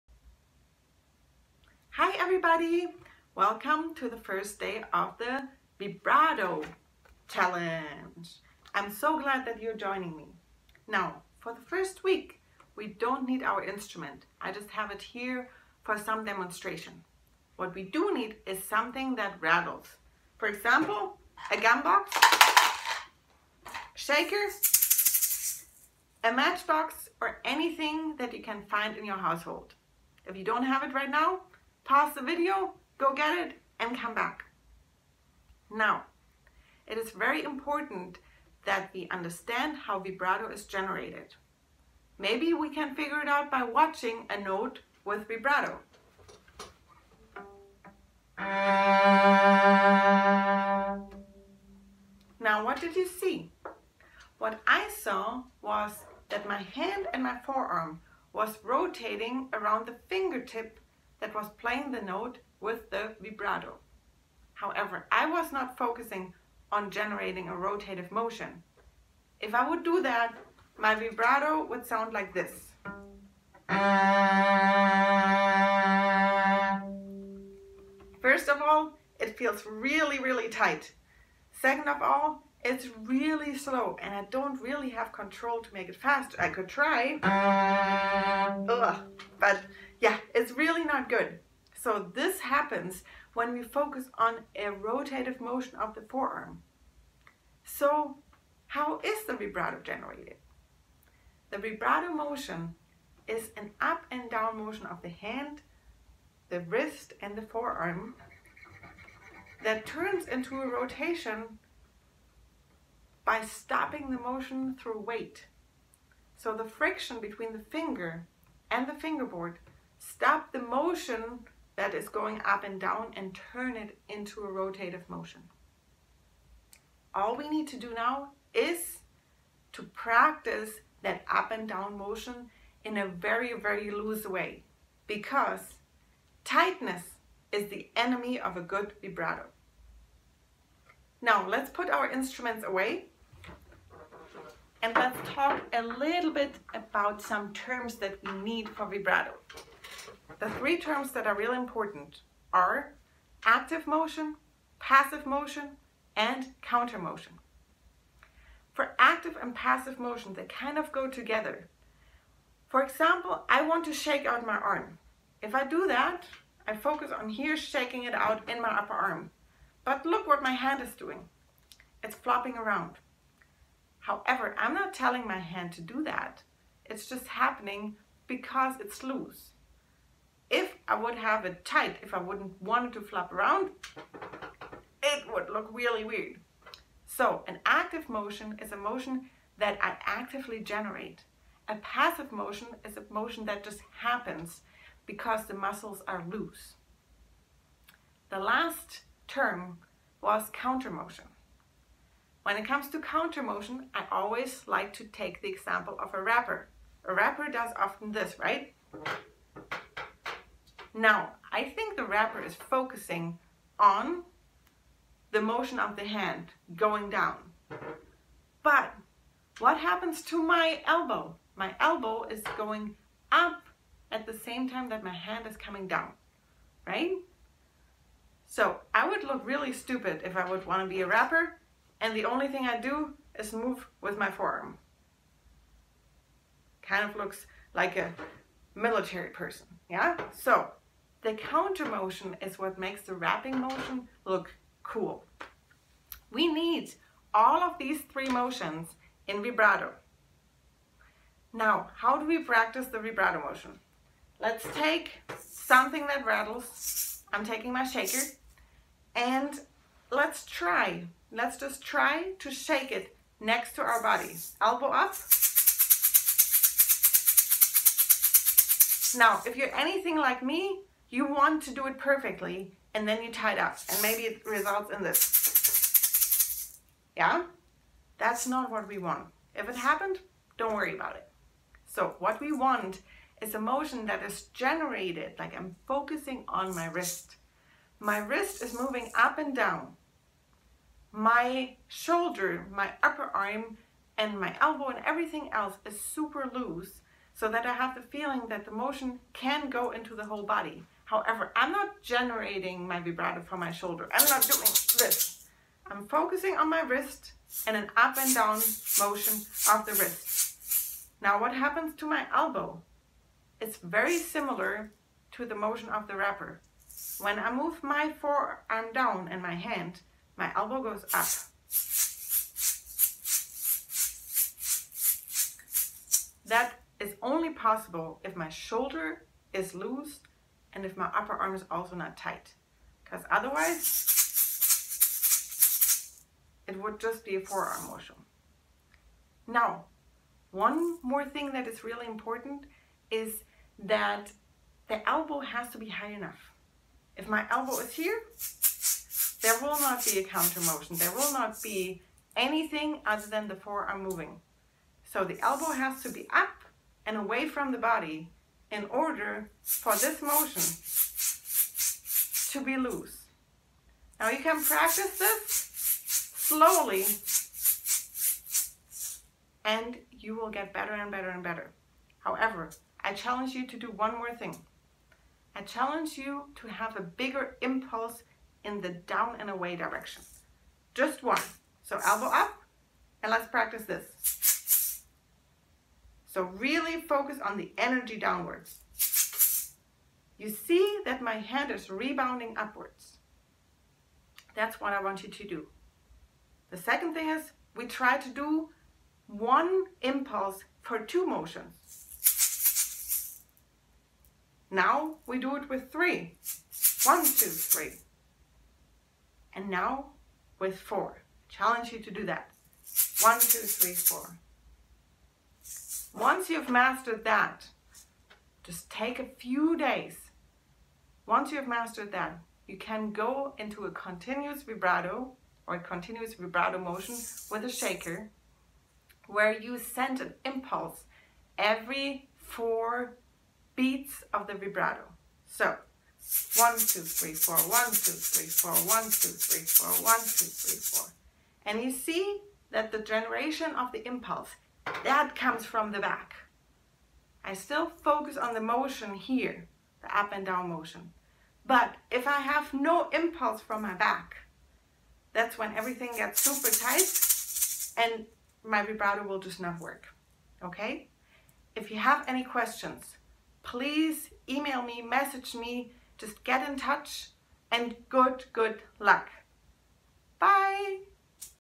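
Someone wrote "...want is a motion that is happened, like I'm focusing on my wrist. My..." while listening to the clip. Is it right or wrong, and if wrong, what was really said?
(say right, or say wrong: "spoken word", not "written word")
wrong: "generated", not "happened".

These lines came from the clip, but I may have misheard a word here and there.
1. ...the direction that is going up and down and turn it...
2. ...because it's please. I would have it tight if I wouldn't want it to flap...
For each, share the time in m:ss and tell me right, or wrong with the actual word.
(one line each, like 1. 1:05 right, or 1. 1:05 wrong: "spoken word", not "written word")
1. 2:00 wrong: "motion", not "direction"
2. 2:58 wrong: "loose", not "please".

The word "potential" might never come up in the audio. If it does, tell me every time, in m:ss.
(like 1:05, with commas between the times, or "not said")
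not said.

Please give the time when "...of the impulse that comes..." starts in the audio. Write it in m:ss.
7:23.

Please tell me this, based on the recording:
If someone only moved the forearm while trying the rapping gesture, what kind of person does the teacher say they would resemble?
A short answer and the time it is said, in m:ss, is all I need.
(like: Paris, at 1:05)
A military person, at 3:58.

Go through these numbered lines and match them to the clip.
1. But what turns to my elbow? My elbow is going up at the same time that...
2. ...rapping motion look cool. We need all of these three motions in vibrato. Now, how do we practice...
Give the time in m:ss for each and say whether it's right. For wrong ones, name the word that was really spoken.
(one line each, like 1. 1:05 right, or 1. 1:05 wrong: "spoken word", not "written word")
1. 3:38 wrong: "happens", not "turns"
2. 4:03 right.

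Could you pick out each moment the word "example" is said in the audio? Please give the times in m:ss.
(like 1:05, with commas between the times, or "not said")
0:20, 2:42, 3:25.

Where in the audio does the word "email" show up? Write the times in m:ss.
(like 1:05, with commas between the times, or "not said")
7:44.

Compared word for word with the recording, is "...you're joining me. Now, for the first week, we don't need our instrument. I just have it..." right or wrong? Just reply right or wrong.
right.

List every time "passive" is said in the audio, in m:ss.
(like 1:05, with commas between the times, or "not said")
2:34, 2:39, 3:11.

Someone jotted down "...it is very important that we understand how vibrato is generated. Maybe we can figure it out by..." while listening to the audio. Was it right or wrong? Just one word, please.
right.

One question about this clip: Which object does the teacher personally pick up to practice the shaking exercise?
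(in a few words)
A shaker.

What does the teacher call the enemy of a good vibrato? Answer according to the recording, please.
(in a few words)
Tightness.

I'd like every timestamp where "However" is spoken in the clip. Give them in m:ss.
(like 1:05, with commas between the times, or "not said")
1:04, 2:53, 5:01, 6:12.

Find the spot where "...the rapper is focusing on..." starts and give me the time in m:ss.
3:31.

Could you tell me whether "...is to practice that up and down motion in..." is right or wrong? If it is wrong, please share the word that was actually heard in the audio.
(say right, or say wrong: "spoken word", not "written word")
right.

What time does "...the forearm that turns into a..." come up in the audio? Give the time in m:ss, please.
1:47.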